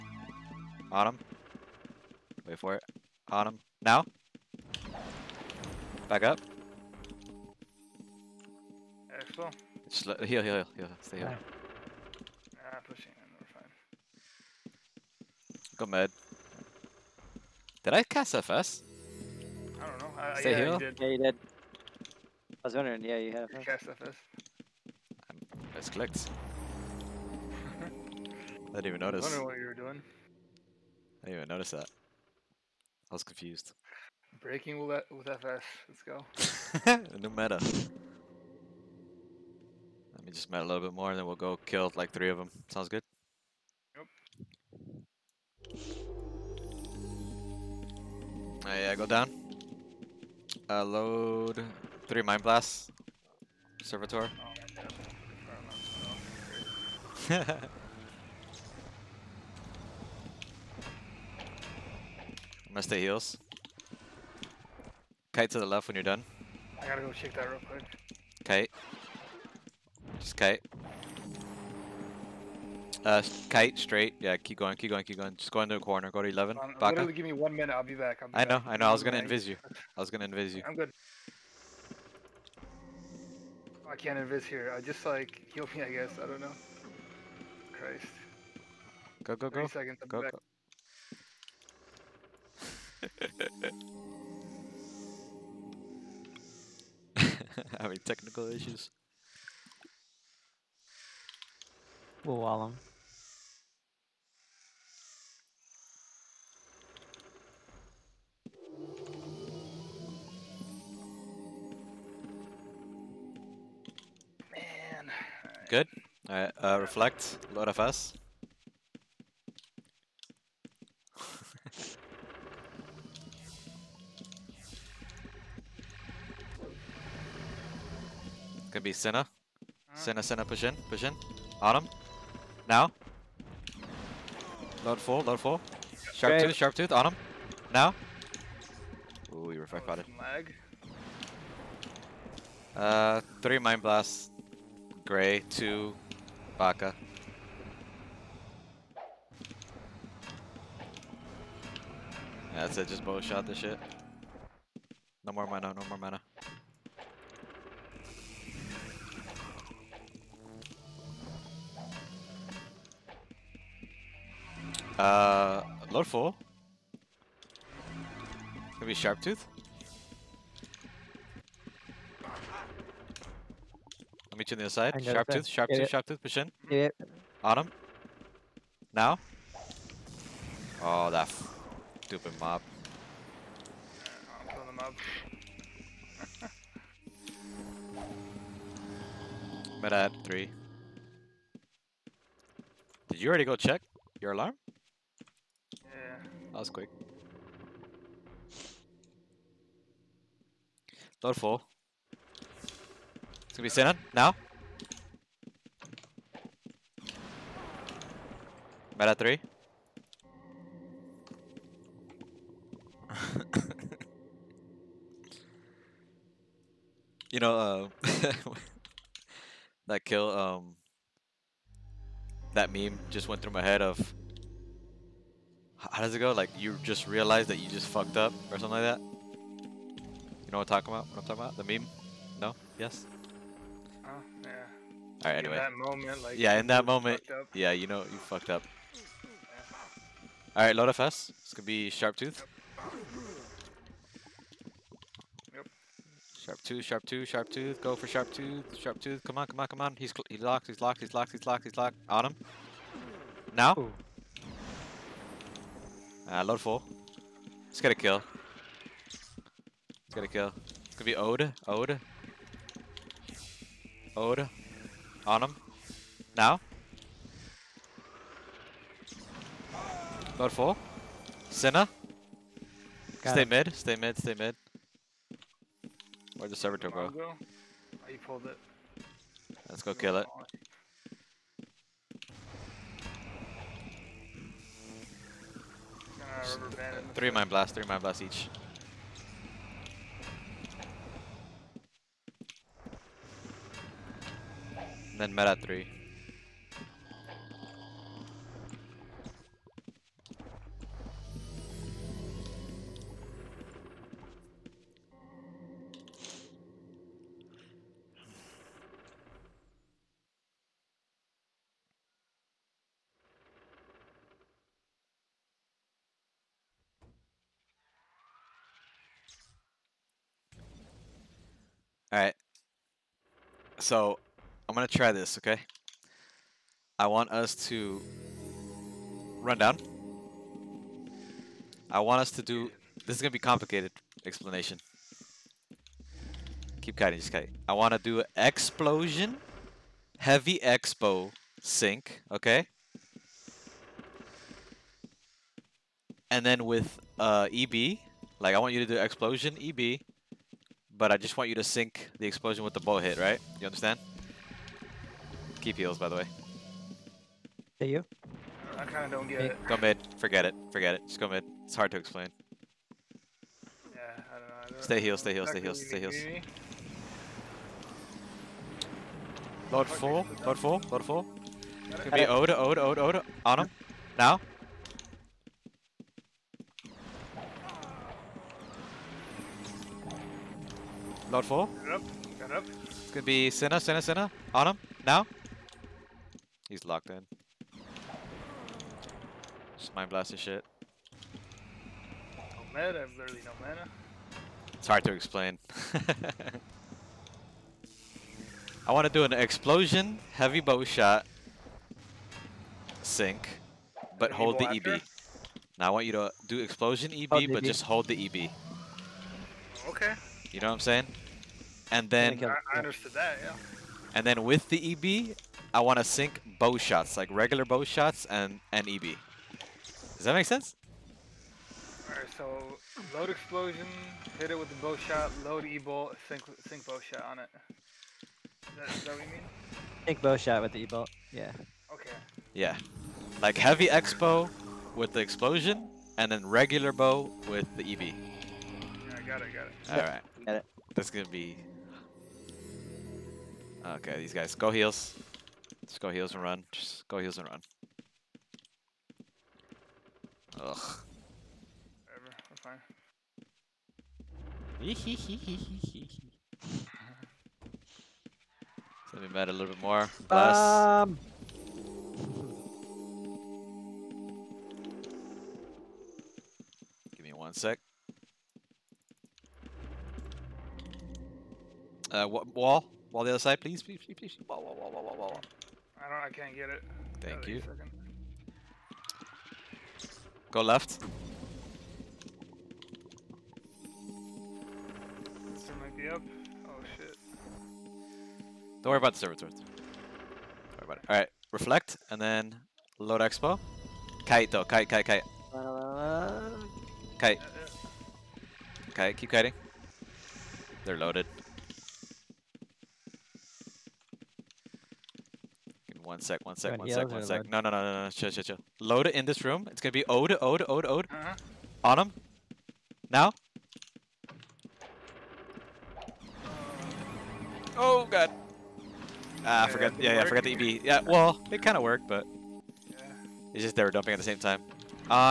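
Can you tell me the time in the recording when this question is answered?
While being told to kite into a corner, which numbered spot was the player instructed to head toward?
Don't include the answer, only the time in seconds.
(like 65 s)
76 s.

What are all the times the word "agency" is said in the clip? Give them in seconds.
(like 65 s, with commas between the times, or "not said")
not said.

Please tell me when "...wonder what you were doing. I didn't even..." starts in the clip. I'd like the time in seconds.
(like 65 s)
29 s.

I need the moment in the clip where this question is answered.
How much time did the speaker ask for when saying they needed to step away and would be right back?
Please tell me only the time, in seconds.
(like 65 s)
77 s.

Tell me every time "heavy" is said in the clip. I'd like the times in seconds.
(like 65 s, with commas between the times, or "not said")
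340 s, 400 s, 433 s.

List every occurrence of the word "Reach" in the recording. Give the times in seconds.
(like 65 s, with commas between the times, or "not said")
174 s.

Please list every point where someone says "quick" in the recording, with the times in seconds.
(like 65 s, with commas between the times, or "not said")
67 s, 196 s.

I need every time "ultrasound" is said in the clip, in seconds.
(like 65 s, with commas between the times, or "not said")
not said.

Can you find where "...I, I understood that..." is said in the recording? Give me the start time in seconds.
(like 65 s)
412 s.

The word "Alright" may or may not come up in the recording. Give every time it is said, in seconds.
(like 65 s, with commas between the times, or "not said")
116 s, 322 s, 422 s, 439 s.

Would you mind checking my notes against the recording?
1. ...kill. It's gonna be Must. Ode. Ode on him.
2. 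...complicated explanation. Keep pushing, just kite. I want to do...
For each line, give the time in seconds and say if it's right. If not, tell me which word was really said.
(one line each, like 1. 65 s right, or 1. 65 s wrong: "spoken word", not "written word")
1. 260 s wrong: "Ode", not "Must"
2. 333 s wrong: "kiting", not "pushing".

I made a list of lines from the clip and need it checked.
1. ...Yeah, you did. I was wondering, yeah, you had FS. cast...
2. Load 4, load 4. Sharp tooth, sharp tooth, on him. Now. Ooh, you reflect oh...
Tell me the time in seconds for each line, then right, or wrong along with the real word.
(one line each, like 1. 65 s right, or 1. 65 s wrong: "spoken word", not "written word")
1. 20 s right
2. 134 s right.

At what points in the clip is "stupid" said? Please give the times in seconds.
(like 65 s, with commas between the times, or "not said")
182 s.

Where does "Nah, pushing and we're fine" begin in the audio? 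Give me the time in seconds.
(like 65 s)
12 s.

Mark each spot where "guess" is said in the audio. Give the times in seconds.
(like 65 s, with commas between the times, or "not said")
85 s.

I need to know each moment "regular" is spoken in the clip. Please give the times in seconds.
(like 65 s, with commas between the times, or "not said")
417 s, 436 s.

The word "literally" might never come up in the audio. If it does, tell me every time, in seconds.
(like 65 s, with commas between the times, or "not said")
76 s, 393 s.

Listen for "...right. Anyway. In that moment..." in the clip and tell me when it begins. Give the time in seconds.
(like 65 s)
235 s.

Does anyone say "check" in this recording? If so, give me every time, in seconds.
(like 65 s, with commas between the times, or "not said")
67 s, 193 s.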